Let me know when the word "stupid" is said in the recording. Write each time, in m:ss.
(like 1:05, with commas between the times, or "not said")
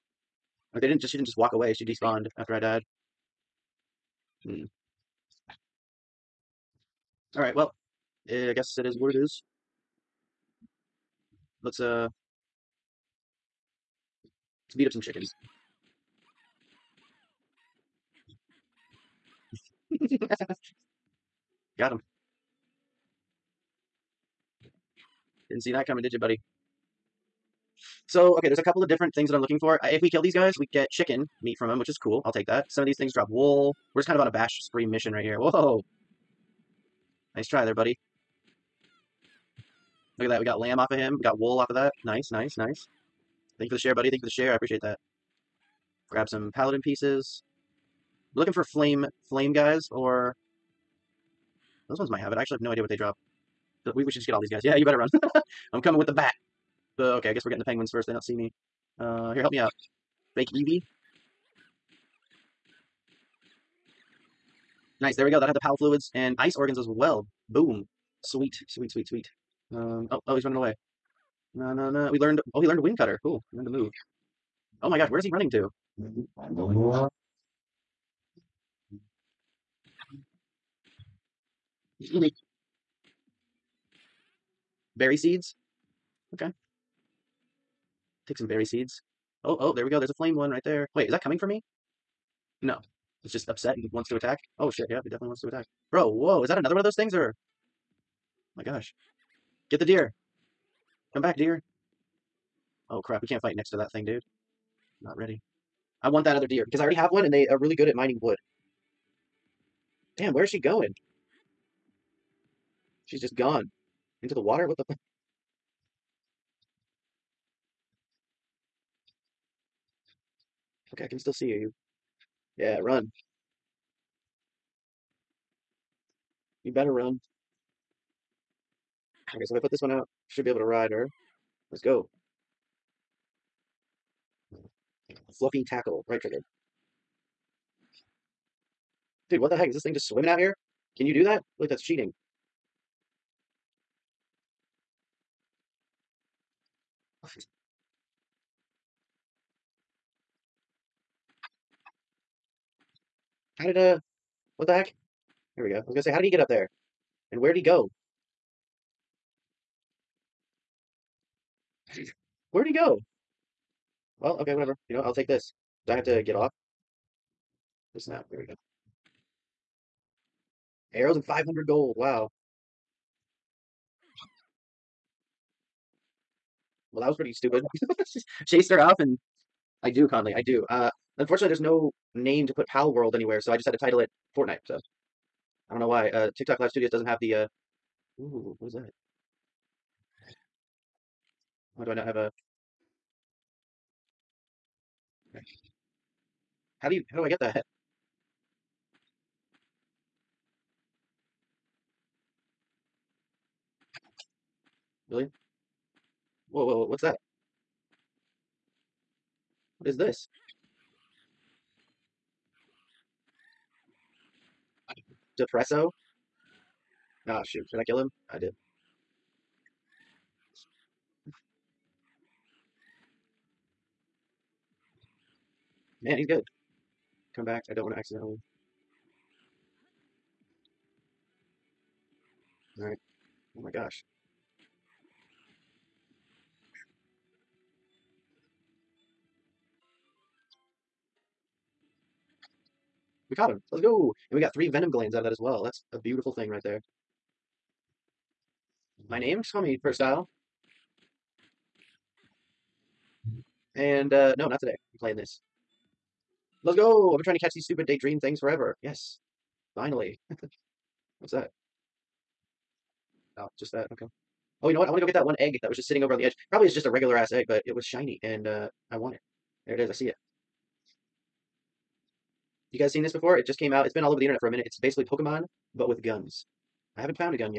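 2:57, 4:17.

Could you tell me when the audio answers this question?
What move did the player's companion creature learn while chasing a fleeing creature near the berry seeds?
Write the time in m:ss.
1:12.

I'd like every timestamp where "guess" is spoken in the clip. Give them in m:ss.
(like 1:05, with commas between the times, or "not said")
0:08, 0:57.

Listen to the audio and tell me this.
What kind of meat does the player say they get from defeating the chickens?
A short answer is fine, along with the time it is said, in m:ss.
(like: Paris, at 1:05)
Chicken meat, at 0:30.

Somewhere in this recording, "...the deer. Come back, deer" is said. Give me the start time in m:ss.
1:39.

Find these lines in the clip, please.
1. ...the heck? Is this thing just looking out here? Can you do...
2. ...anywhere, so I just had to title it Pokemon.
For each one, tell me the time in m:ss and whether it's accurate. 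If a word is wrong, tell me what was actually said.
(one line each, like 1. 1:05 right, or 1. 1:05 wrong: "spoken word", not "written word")
1. 2:19 wrong: "swimming", not "looking"
2. 3:03 wrong: "Fortnite", not "Pokemon".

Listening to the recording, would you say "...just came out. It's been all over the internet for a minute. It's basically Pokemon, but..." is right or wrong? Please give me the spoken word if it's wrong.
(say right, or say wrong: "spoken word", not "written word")
right.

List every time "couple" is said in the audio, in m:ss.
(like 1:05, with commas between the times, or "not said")
0:28.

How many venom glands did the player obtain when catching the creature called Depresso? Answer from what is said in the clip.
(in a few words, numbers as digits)
3.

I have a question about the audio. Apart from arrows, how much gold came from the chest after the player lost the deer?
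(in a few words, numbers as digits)
500.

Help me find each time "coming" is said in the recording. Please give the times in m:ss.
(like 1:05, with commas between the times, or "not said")
0:25, 0:55, 1:31.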